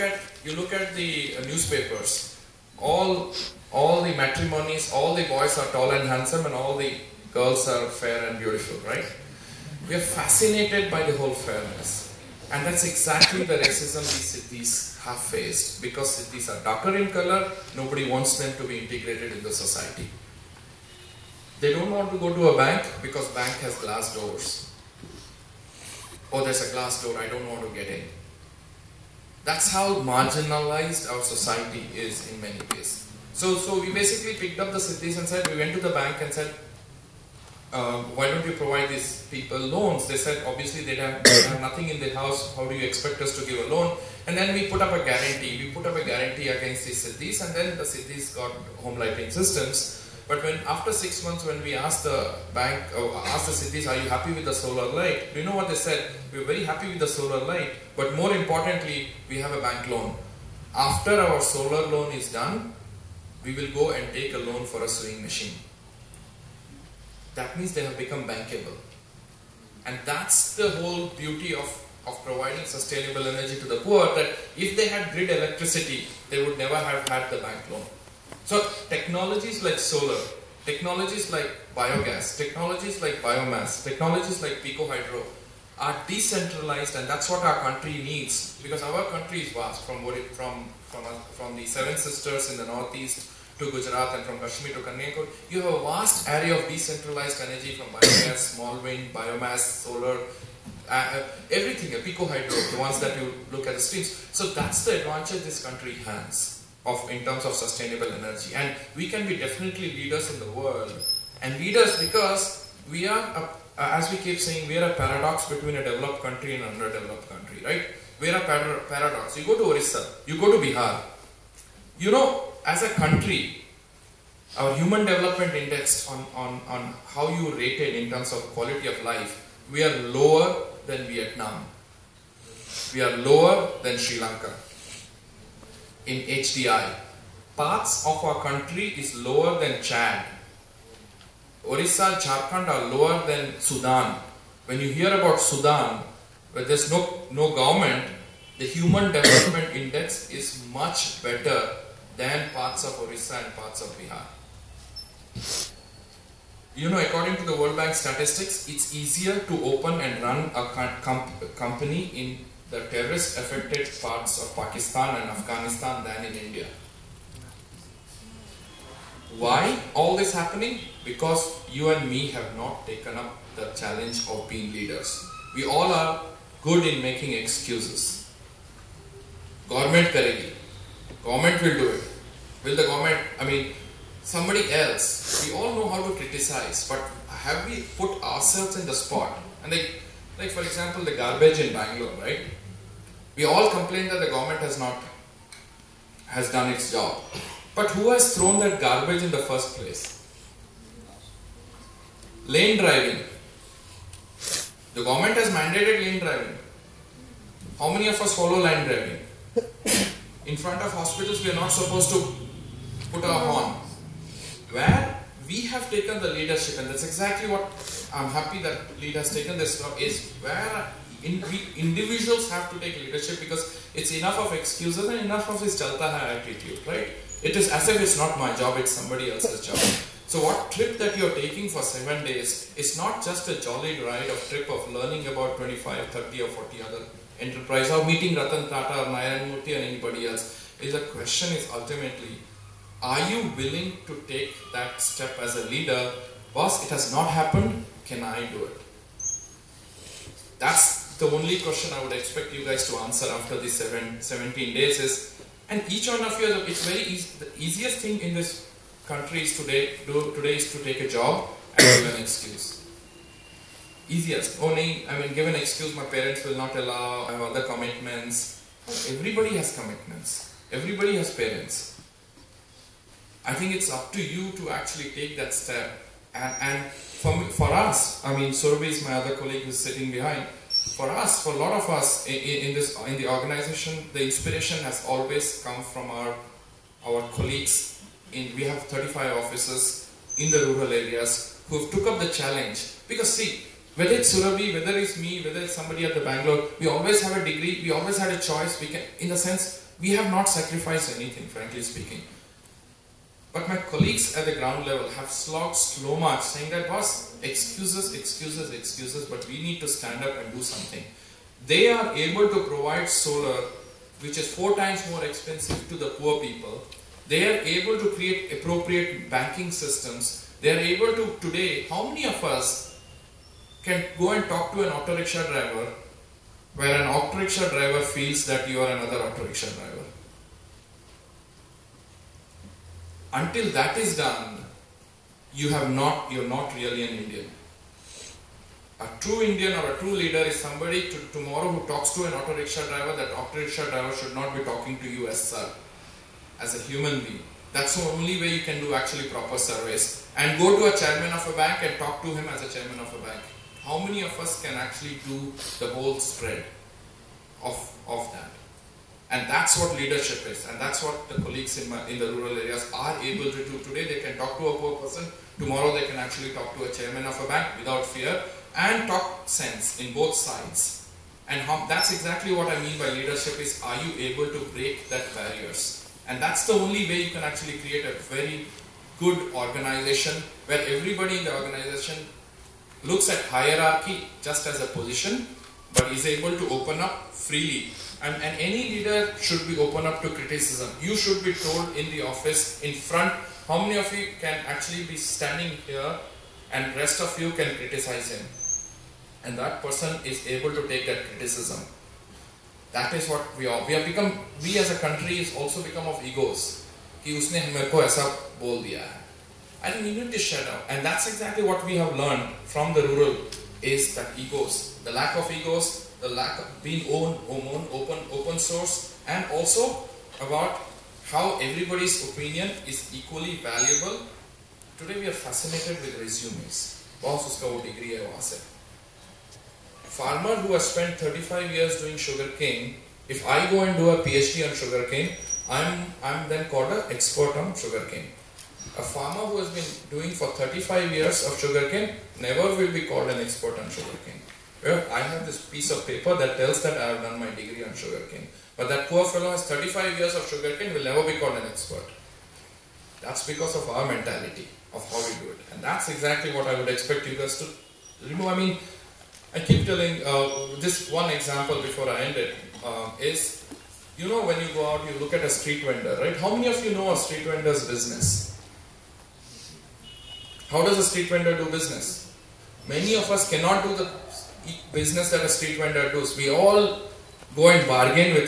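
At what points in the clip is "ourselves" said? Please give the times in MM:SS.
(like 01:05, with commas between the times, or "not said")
03:08.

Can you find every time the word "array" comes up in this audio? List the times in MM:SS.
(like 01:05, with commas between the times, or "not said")
01:36.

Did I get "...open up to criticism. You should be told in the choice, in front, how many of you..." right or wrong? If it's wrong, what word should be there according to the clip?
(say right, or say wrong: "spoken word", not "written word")
wrong: "office", not "choice".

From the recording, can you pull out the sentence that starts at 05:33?
until that is done, you have not, you're not really an Indian.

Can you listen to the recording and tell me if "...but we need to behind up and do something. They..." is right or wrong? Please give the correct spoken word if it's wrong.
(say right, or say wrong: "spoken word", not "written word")
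wrong: "stand", not "behind".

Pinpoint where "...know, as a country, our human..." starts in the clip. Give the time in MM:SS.
02:02.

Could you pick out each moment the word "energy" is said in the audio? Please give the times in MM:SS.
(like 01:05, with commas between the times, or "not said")
01:13, 01:37, 01:48.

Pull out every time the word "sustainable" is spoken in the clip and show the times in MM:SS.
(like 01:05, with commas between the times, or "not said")
01:12, 01:47.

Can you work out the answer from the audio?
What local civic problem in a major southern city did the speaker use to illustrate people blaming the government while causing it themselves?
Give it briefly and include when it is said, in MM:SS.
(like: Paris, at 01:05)
garbage in Bangalore, at 03:11.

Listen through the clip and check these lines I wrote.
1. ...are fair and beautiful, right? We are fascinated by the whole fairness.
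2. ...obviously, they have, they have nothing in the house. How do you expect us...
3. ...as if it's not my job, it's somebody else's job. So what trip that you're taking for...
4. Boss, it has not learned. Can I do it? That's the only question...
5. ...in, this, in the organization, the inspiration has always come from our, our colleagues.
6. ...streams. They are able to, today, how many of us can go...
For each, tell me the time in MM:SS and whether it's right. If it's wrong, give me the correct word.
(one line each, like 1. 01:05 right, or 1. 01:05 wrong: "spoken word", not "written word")
1. 00:07 right
2. 00:40 right
3. 03:47 right
4. 04:06 wrong: "happened", not "learned"
5. 04:42 right
6. 05:19 wrong: "systems", not "streams".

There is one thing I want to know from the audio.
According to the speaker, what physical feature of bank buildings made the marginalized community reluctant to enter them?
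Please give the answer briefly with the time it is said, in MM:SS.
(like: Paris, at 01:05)
glass doors, at 00:23.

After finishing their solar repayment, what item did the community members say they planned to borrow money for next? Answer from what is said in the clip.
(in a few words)
sewing machine.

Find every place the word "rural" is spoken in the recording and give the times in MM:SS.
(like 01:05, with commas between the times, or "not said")
04:50, 06:02, 06:53.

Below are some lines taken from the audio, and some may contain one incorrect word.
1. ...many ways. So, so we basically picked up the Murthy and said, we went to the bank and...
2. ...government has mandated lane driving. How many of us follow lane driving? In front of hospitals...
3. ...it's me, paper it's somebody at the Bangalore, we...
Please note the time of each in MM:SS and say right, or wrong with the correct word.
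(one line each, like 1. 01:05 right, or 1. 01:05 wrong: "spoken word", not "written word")
1. 00:32 wrong: "Siddis", not "Murthy"
2. 03:25 right
3. 04:54 wrong: "whether", not "paper".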